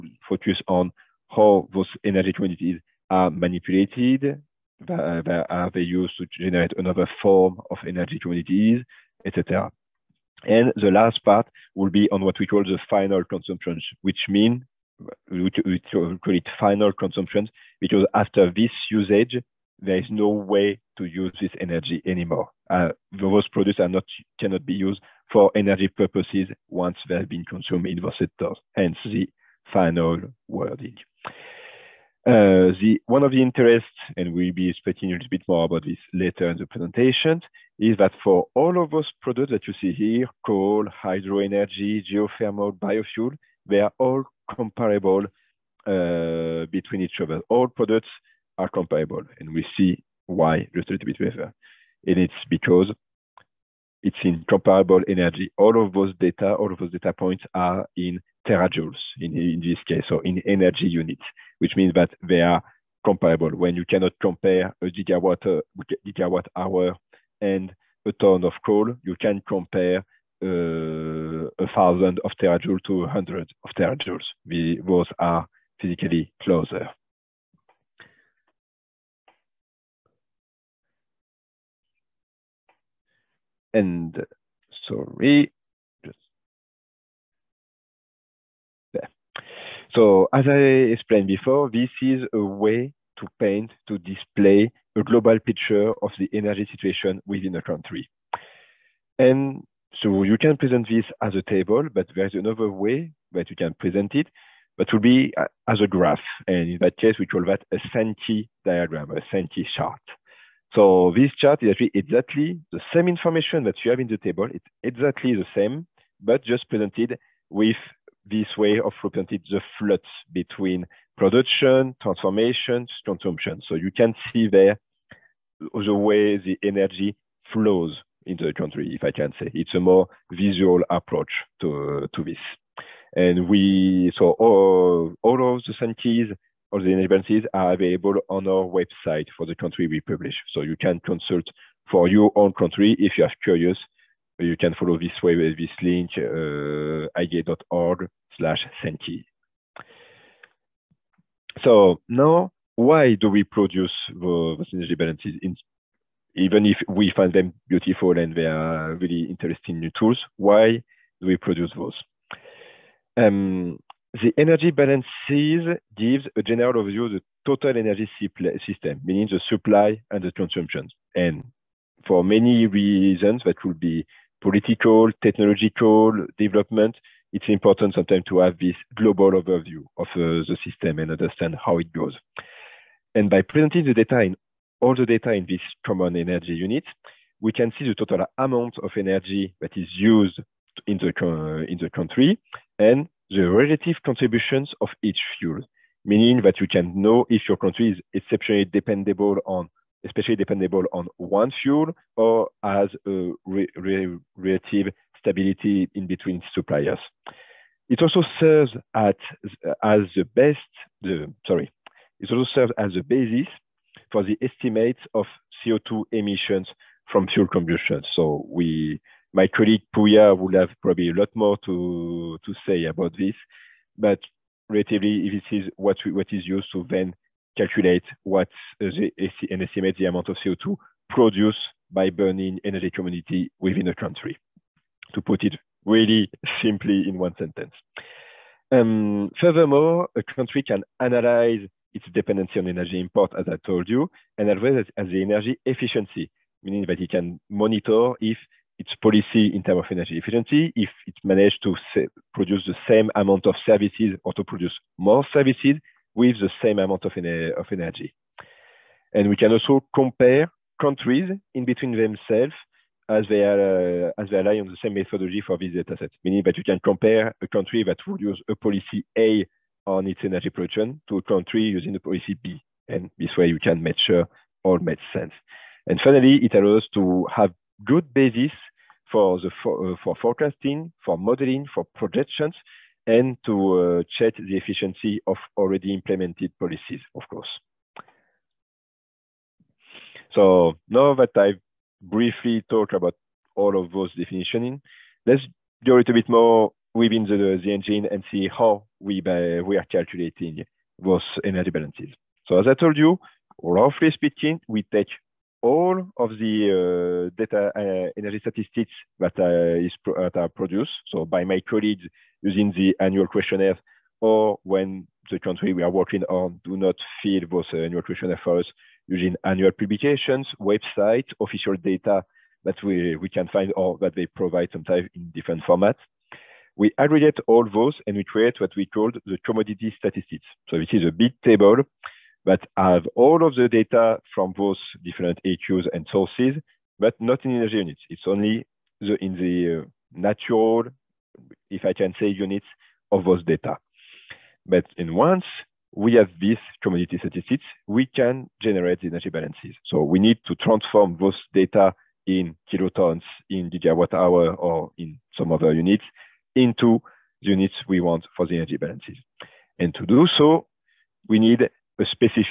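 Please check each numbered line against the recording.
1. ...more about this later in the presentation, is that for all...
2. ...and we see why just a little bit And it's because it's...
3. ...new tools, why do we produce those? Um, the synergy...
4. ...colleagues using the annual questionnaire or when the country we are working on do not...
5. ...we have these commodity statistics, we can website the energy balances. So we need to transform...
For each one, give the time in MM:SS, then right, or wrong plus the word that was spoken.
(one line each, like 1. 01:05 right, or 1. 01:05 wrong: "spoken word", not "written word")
1. 00:35 right
2. 00:49 right
3. 02:39 wrong: "energy", not "synergy"
4. 05:11 right
5. 05:45 wrong: "generate", not "website".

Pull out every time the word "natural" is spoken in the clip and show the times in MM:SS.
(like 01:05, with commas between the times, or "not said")
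05:40.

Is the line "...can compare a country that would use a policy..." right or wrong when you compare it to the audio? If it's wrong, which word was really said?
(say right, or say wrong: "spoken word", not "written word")
right.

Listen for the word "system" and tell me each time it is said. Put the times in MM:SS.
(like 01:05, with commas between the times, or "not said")
02:48, 03:00.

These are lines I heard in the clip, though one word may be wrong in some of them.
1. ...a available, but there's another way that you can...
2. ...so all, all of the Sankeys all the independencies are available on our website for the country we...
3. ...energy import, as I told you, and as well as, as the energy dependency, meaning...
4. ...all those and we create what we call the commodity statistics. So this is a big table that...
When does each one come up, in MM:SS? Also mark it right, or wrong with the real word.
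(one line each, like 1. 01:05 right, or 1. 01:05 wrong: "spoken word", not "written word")
1. 01:41 wrong: "table", not "available"
2. 02:14 right
3. 04:02 wrong: "efficiency", not "dependency"
4. 05:27 right.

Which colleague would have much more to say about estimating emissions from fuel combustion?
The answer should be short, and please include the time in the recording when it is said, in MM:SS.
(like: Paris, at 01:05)
Puya, at 03:39.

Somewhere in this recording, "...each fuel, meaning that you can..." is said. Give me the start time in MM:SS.
03:15.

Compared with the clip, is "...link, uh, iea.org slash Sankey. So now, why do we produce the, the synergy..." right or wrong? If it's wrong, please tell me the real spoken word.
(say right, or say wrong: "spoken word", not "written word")
right.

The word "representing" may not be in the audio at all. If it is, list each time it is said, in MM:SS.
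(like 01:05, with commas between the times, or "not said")
01:59.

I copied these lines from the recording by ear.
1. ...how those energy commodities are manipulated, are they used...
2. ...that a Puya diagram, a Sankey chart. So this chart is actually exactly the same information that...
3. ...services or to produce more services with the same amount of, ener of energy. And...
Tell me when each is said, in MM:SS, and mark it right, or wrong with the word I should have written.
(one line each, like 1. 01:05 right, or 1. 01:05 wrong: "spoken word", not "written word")
1. 00:01 right
2. 01:47 wrong: "Sankey", not "Puya"
3. 04:13 right.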